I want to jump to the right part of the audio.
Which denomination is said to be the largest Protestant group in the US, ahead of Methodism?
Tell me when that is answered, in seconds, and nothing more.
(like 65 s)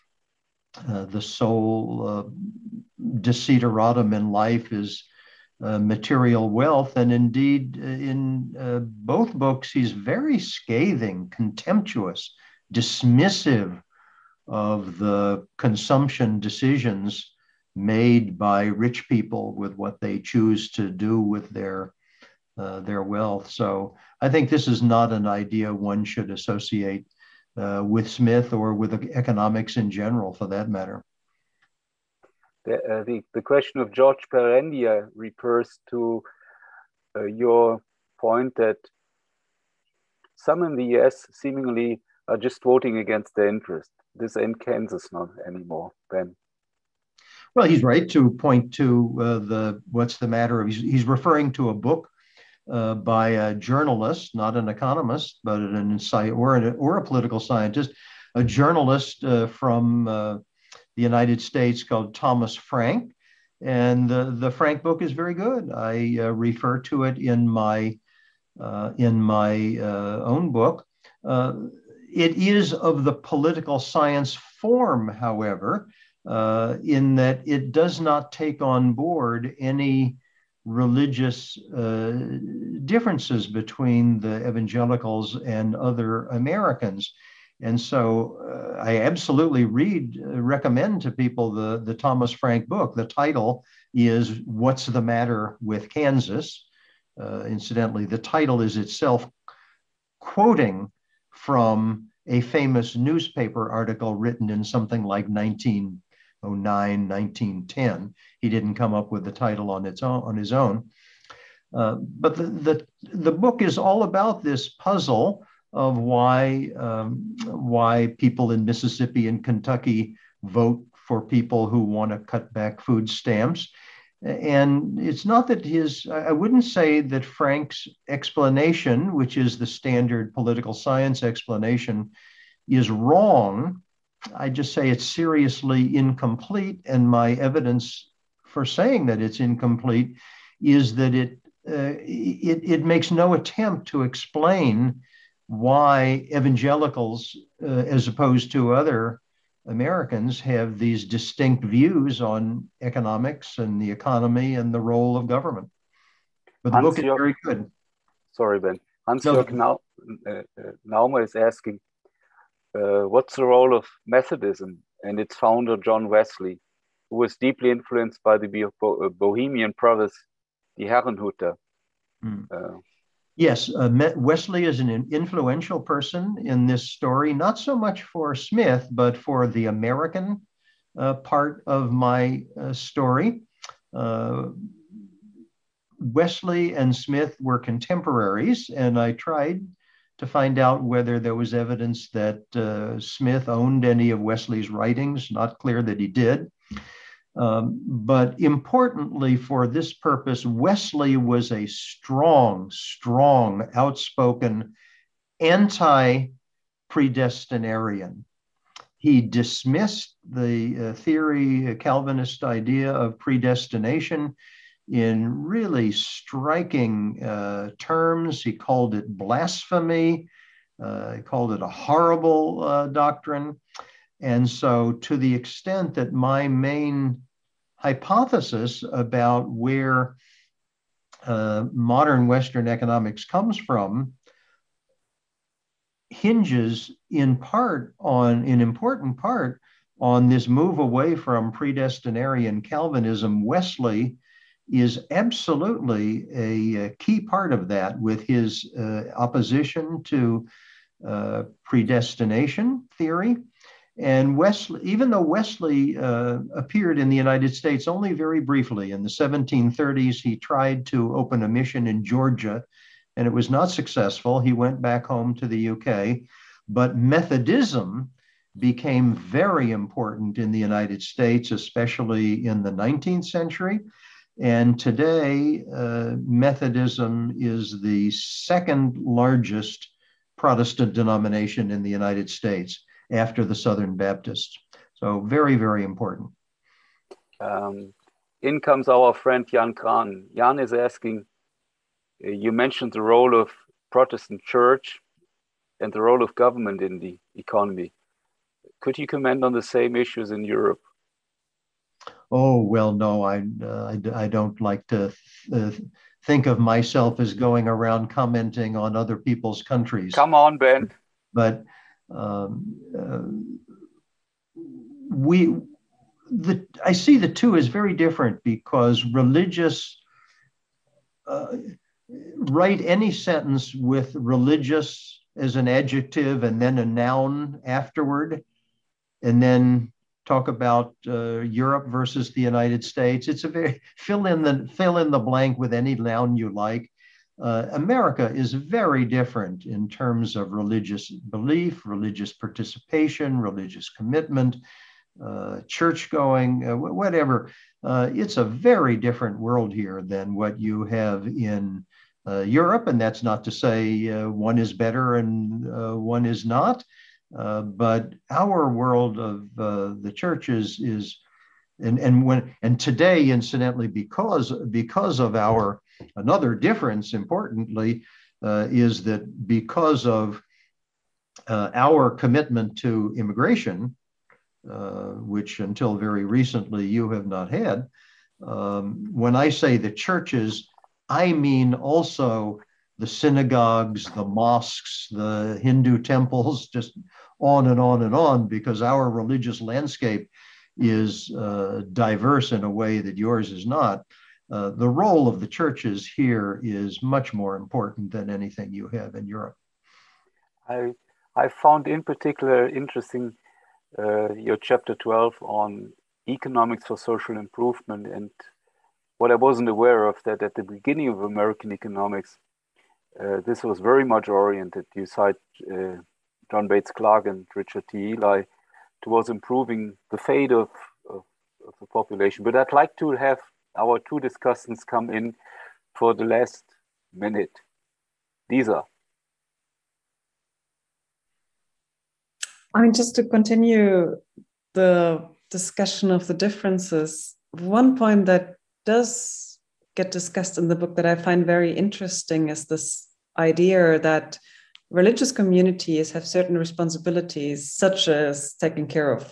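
283 s.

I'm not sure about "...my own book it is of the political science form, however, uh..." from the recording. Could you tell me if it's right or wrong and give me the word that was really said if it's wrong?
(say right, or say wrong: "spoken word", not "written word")
right.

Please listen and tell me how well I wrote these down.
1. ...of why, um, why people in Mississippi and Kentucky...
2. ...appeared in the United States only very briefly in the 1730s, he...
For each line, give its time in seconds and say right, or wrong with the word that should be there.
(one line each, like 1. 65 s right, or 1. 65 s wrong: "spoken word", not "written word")
1. 115 s right
2. 256 s right.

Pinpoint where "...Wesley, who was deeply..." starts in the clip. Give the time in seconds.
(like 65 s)
166 s.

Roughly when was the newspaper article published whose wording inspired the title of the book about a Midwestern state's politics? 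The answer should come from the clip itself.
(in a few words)
1909.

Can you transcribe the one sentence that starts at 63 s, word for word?
And the, the Frank book is very good.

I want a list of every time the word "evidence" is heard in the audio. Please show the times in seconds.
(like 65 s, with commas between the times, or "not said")
137 s, 191 s.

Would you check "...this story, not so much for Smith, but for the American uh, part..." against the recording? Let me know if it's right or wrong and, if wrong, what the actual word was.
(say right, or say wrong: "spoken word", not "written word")
right.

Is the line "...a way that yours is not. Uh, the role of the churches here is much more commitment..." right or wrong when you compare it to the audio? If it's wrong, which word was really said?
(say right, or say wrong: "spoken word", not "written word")
wrong: "important", not "commitment".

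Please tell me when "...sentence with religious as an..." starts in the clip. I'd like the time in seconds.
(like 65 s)
323 s.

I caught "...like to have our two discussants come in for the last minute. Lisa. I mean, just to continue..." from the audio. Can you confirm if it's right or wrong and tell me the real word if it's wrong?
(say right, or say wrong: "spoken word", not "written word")
right.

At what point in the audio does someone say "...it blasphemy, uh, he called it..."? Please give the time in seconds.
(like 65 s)
218 s.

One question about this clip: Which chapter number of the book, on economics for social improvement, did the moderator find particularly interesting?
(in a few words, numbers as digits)
12.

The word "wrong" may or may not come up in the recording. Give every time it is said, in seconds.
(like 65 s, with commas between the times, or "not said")
132 s.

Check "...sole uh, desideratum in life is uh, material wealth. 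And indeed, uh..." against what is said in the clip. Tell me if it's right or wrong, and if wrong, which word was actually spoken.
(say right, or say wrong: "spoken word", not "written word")
right.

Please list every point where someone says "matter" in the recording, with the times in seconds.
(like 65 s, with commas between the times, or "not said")
30 s, 50 s, 95 s.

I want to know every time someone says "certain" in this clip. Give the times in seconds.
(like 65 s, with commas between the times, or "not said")
446 s.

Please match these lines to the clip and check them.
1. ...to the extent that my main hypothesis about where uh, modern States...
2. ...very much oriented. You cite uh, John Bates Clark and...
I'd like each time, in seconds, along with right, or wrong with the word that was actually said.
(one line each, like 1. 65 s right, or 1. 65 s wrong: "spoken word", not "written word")
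1. 224 s wrong: "Western", not "States"
2. 413 s right.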